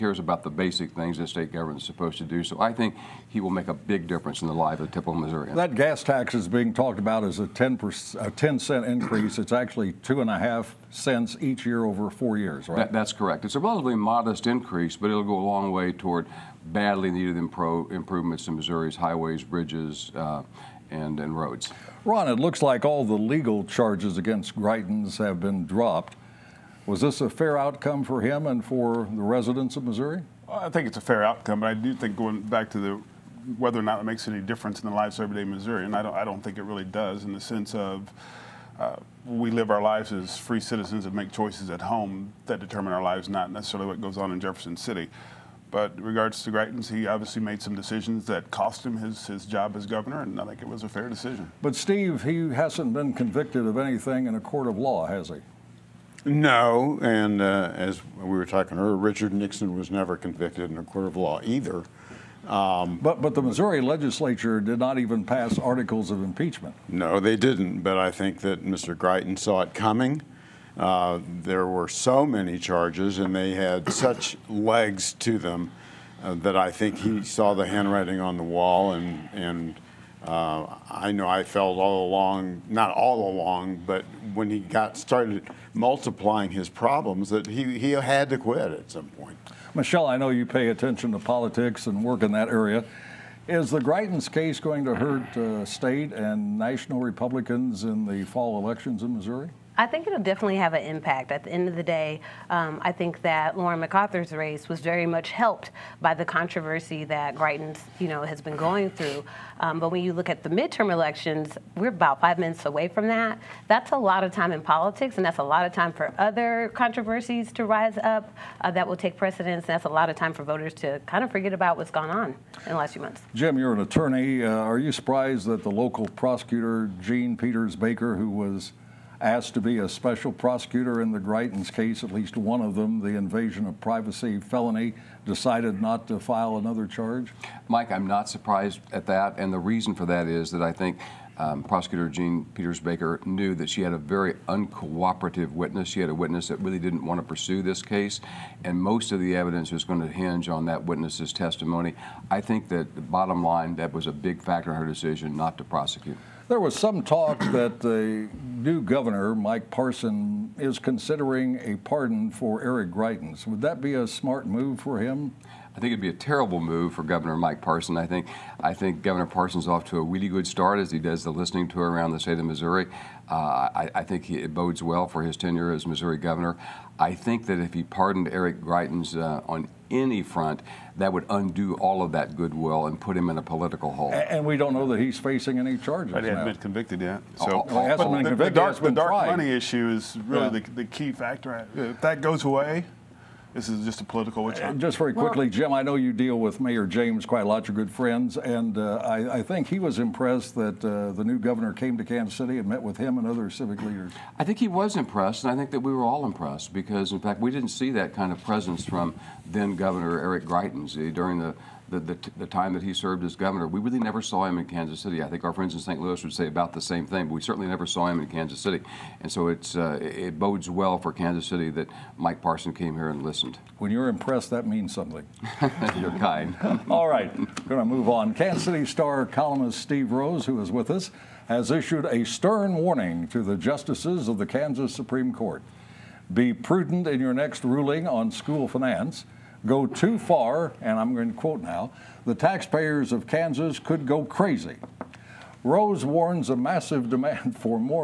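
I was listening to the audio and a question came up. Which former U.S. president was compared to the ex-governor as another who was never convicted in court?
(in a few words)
Richard Nixon.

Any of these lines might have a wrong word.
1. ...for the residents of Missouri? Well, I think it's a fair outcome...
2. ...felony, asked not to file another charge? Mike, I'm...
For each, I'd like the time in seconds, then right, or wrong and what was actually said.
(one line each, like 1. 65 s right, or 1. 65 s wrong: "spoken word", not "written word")
1. 28 s right
2. 134 s wrong: "decided", not "asked".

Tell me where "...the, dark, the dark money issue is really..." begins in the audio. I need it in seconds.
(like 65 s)
188 s.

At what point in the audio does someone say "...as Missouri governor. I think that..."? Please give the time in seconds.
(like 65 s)
175 s.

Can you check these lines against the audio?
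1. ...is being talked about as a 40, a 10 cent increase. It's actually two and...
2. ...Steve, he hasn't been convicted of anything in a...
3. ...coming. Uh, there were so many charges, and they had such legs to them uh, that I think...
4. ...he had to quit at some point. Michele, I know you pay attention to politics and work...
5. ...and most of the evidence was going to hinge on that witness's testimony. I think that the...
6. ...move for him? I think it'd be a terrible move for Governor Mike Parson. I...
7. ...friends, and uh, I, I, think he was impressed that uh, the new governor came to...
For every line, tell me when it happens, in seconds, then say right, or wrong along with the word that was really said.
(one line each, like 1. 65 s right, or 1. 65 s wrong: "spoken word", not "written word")
1. 6 s wrong: "10", not "40"
2. 51 s right
3. 69 s right
4. 87 s right
5. 148 s right
6. 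164 s right
7. 197 s right.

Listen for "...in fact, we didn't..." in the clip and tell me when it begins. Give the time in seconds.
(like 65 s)
207 s.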